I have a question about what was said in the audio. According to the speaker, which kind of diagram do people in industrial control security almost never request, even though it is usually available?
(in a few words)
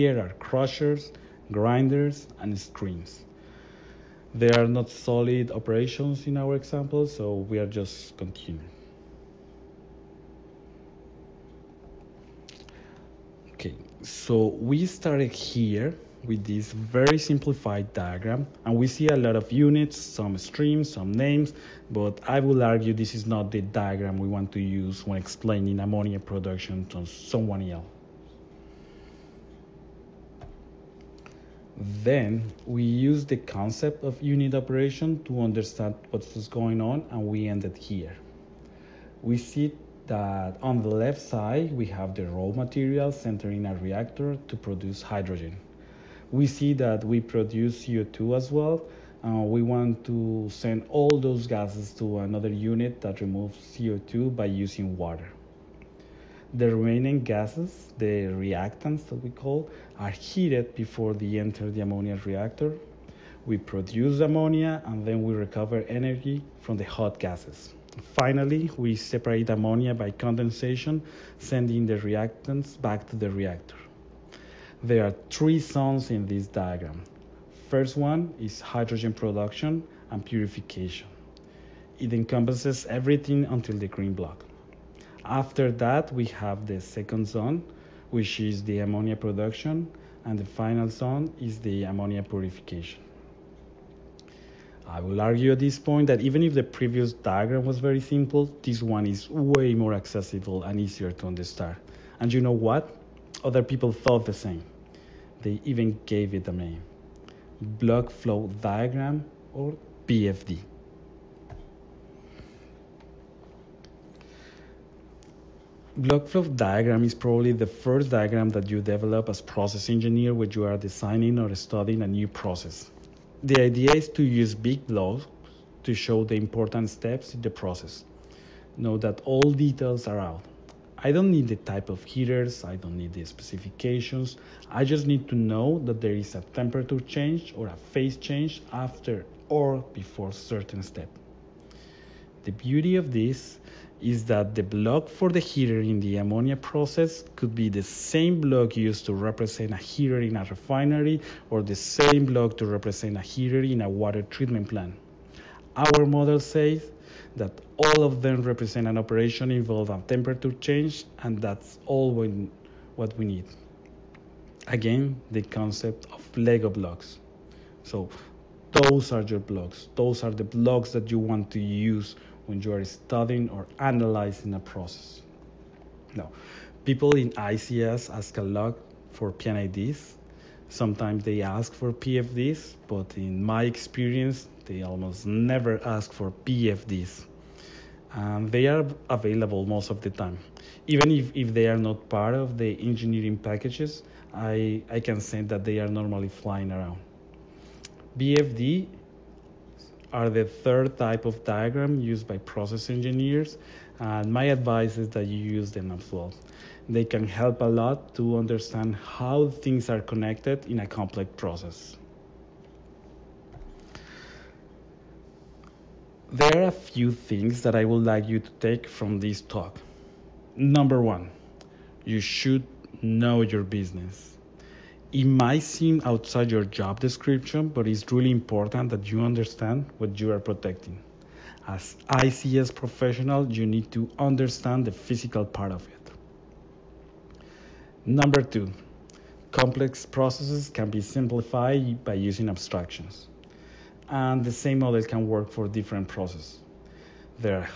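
BFDs.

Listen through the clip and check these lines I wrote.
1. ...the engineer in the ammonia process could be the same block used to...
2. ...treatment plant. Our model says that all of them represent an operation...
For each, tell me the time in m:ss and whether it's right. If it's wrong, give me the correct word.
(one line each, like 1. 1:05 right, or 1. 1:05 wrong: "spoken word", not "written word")
1. 2:25 wrong: "heater", not "engineer"
2. 2:34 right.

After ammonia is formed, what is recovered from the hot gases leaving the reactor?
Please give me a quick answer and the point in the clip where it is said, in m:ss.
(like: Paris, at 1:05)
Energy, at 1:05.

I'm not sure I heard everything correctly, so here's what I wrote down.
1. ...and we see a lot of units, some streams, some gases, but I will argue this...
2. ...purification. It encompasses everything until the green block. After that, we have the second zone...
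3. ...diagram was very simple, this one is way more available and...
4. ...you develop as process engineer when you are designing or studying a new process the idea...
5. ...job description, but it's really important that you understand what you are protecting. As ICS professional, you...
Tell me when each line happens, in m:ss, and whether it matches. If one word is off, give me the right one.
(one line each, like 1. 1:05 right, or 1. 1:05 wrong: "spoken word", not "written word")
1. 0:18 wrong: "names", not "gases"
2. 1:20 right
3. 1:37 wrong: "accessible", not "available"
4. 1:58 right
5. 3:46 right.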